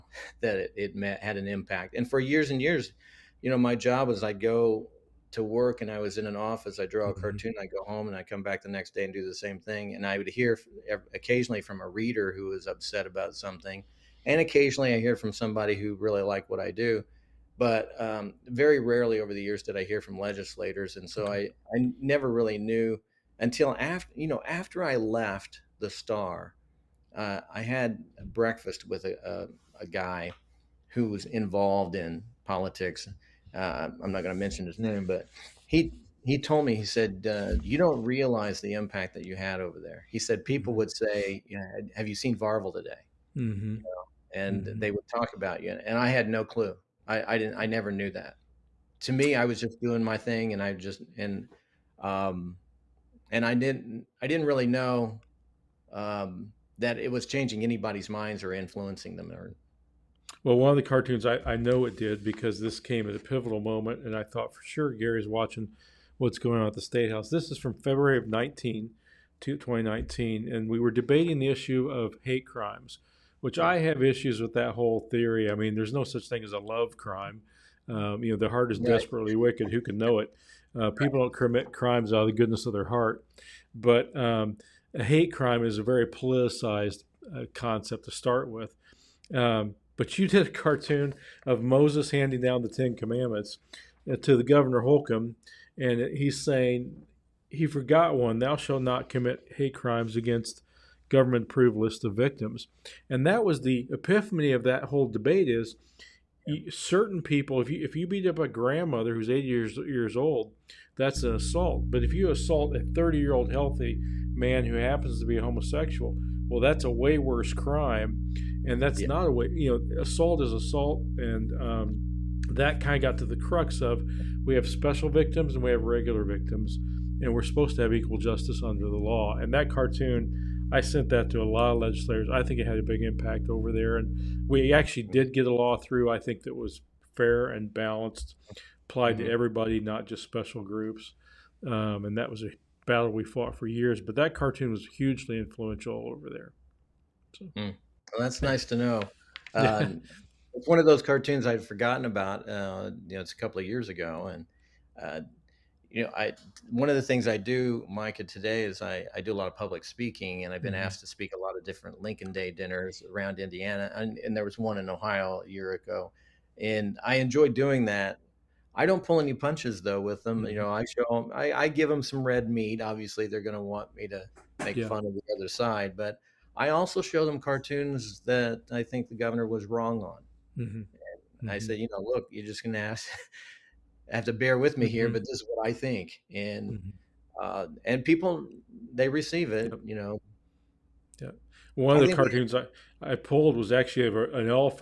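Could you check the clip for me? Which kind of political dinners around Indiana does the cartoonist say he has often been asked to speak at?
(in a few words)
Lincoln Day dinners.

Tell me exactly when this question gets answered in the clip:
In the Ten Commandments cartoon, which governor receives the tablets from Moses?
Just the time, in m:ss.
1:34.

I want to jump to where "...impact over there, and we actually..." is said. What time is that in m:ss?
2:13.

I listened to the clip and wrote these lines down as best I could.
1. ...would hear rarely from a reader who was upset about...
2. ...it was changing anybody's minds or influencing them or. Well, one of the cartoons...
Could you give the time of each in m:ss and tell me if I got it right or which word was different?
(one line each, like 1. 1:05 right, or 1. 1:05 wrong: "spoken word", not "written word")
1. 0:10 wrong: "occasionally", not "rarely"
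2. 0:56 right.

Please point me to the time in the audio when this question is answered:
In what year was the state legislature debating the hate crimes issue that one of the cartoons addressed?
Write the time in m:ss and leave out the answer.
1:09.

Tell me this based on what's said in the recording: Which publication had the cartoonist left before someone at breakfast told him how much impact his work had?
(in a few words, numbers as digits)
the Star.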